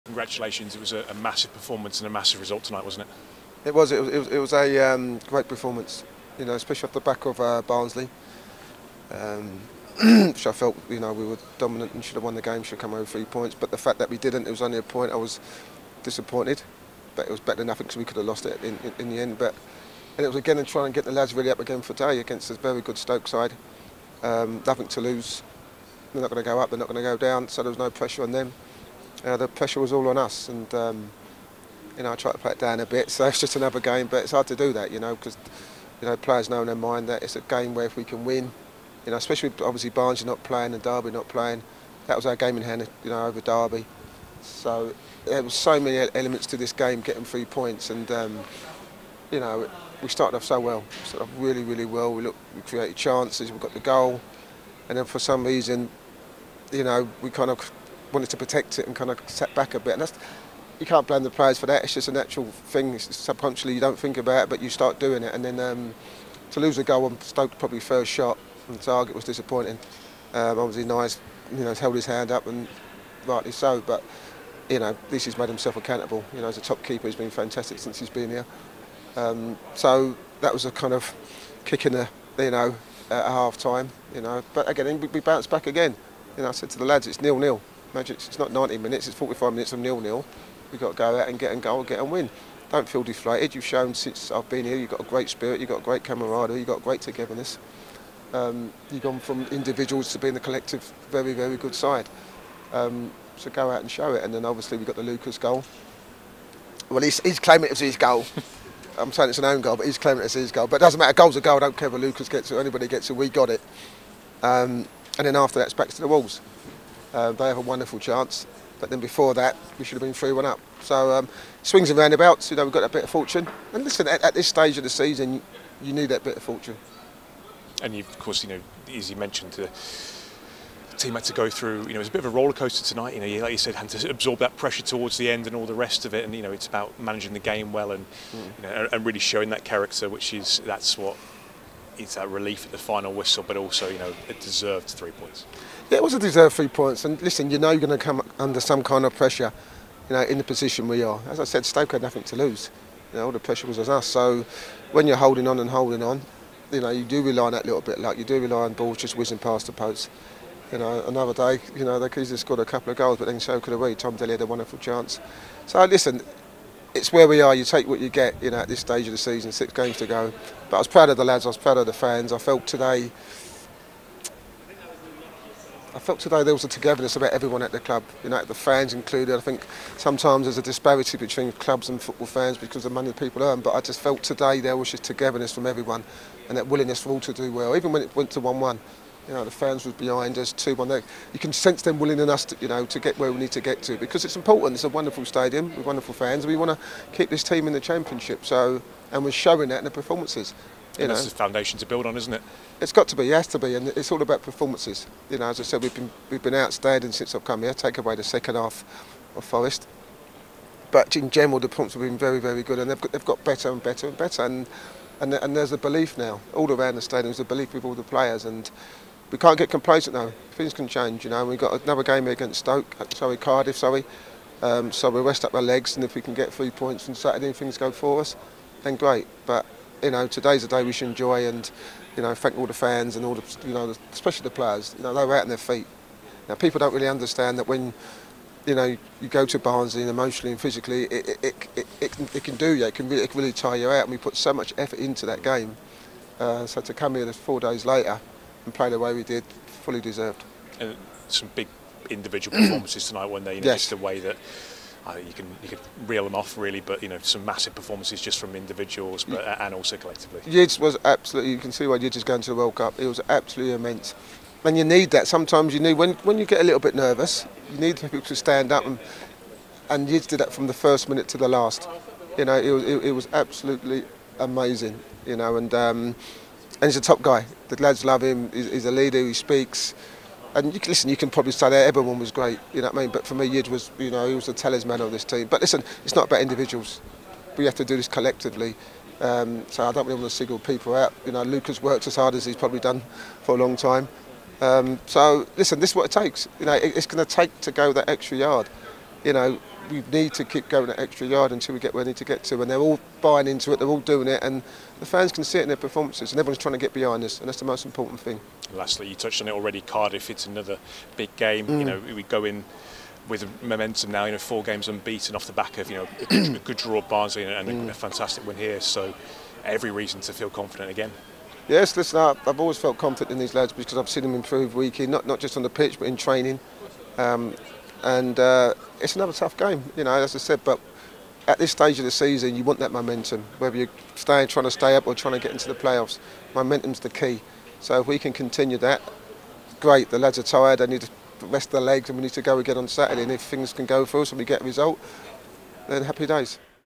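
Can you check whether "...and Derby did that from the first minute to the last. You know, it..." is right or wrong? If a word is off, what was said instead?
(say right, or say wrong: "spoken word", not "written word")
wrong: "Yids", not "Derby".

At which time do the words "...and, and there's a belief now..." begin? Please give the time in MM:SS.
03:35.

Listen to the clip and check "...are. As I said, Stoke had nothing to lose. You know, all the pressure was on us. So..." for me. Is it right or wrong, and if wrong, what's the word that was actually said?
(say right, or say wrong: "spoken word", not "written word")
right.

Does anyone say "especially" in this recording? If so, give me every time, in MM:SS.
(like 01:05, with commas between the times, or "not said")
00:06, 00:39, 03:54.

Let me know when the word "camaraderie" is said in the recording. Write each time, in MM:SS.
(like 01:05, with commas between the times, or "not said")
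01:36.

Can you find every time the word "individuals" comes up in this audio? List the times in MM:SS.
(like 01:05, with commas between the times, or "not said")
01:39, 04:12, 04:18, 04:46.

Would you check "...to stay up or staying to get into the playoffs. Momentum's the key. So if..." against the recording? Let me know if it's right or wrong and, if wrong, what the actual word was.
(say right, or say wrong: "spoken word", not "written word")
wrong: "trying", not "staying".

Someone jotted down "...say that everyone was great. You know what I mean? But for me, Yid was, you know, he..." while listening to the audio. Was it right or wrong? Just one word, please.
right.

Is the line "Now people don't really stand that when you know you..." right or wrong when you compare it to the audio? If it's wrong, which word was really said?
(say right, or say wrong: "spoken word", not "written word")
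wrong: "understand", not "stand".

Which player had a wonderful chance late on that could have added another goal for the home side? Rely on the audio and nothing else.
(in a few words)
Tom Dele.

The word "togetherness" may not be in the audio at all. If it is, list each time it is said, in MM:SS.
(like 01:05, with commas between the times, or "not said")
01:37, 02:56, 03:05.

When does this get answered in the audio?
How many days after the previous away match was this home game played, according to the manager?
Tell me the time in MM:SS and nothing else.
04:07.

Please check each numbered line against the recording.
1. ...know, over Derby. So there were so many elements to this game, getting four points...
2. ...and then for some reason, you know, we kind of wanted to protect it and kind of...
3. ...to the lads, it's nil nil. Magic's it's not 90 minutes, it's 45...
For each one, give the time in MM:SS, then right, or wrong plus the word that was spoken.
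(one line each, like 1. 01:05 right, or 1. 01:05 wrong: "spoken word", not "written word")
1. 00:43 wrong: "three", not "four"
2. 00:54 right
3. 01:26 right.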